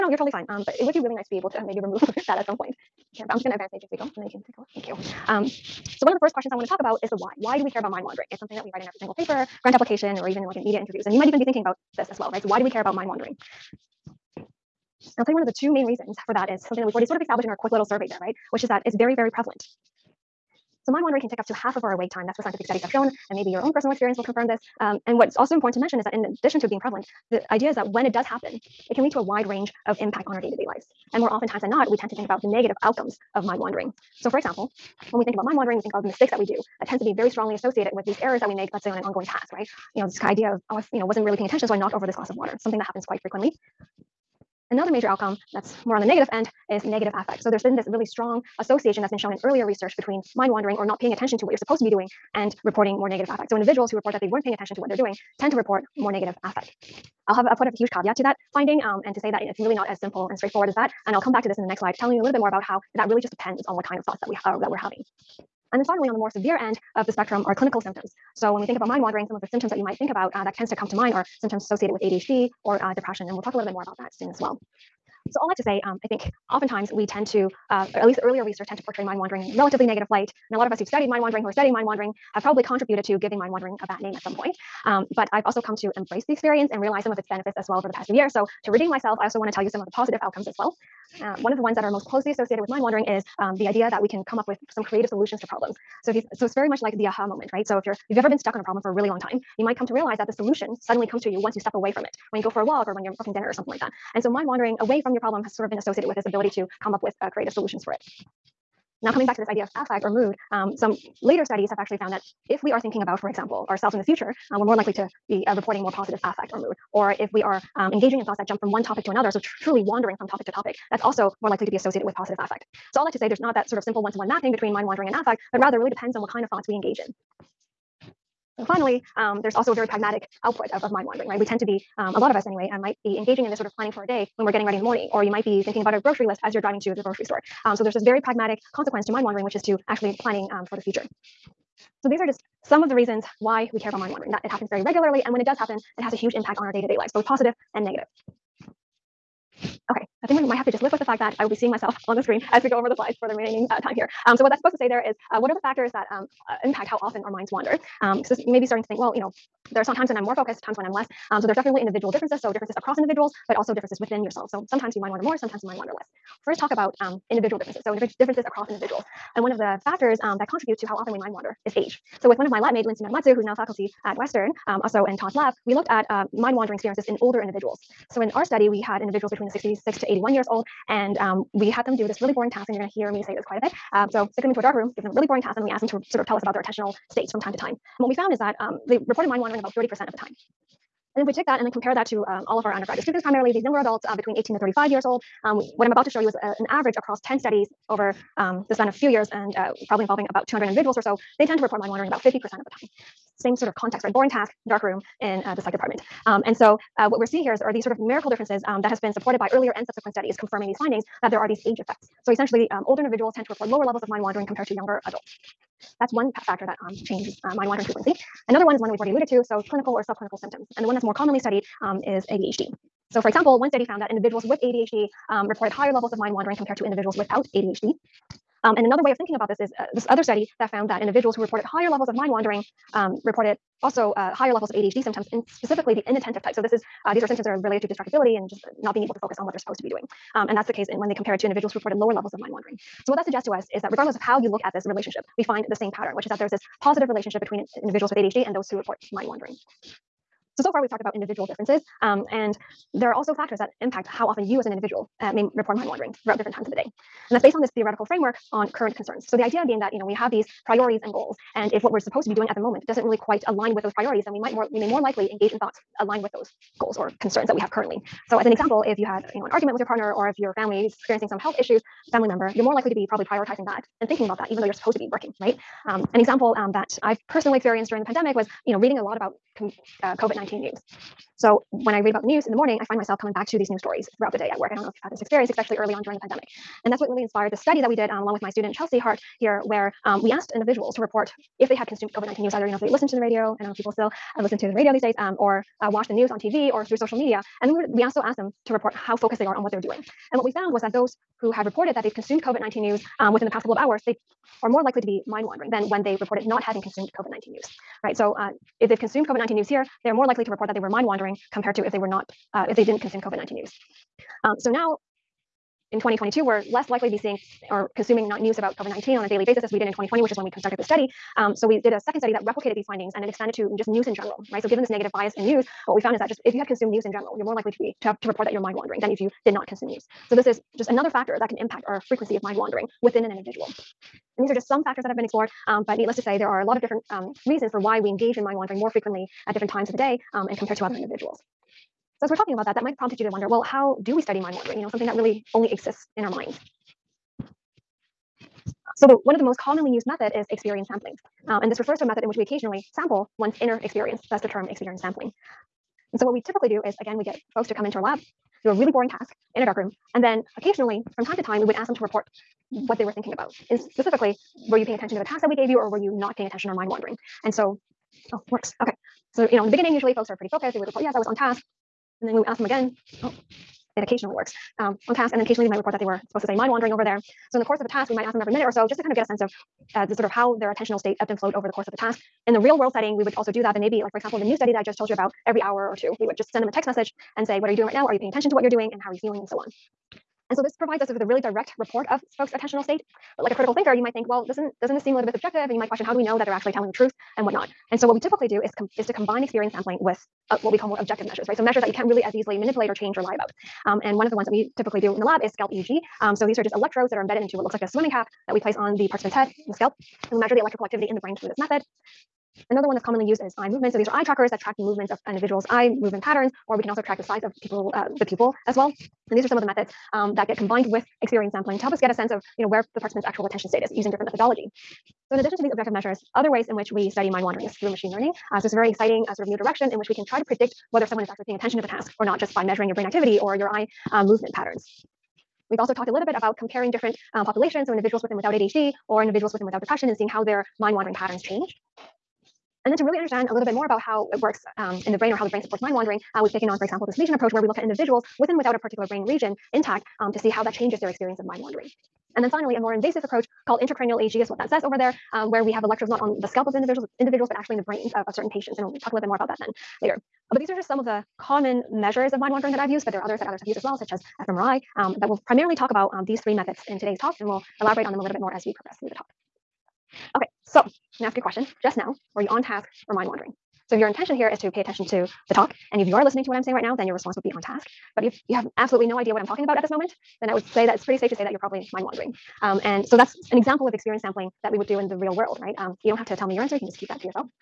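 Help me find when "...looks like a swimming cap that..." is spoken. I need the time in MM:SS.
06:47.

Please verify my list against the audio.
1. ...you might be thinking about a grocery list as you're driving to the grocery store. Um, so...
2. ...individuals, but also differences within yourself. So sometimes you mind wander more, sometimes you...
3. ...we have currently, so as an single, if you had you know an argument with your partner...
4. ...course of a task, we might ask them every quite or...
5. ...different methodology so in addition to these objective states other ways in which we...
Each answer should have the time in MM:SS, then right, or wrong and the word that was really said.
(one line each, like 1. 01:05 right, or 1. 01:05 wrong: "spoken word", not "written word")
1. 02:15 right
2. 02:42 right
3. 04:27 wrong: "example", not "single"
4. 06:17 wrong: "minute", not "quite"
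5. 07:04 wrong: "measures", not "states".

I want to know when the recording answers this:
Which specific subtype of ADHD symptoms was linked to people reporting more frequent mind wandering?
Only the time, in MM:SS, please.
03:56.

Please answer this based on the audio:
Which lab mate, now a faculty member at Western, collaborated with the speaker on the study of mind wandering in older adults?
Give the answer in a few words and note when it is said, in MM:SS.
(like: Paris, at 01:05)
Lindsay Nagamatsu, at 02:52.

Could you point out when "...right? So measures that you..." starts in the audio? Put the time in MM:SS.
06:41.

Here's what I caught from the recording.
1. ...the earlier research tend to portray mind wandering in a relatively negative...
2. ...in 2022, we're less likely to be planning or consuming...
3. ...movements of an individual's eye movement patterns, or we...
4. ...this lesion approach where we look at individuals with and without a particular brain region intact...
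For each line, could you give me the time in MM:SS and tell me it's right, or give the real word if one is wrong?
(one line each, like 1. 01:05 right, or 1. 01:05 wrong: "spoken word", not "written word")
1. 01:18 right
2. 05:15 wrong: "seeing", not "planning"
3. 06:54 right
4. 07:27 right.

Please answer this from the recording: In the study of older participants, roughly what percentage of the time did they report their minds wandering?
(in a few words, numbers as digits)
30%.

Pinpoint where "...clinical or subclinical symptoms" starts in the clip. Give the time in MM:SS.
03:39.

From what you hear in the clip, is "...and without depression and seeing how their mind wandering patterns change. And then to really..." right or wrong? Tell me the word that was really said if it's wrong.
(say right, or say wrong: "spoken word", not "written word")
right.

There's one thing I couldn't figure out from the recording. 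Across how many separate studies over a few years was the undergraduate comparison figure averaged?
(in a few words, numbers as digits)
10.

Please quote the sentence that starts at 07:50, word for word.
Okay, so I'm gonna ask you a question.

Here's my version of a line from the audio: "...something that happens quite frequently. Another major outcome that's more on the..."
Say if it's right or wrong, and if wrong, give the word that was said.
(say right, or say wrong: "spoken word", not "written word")
right.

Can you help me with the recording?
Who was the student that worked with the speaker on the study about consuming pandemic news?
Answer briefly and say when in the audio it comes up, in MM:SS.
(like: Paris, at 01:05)
Chelsea Hart, at 04:48.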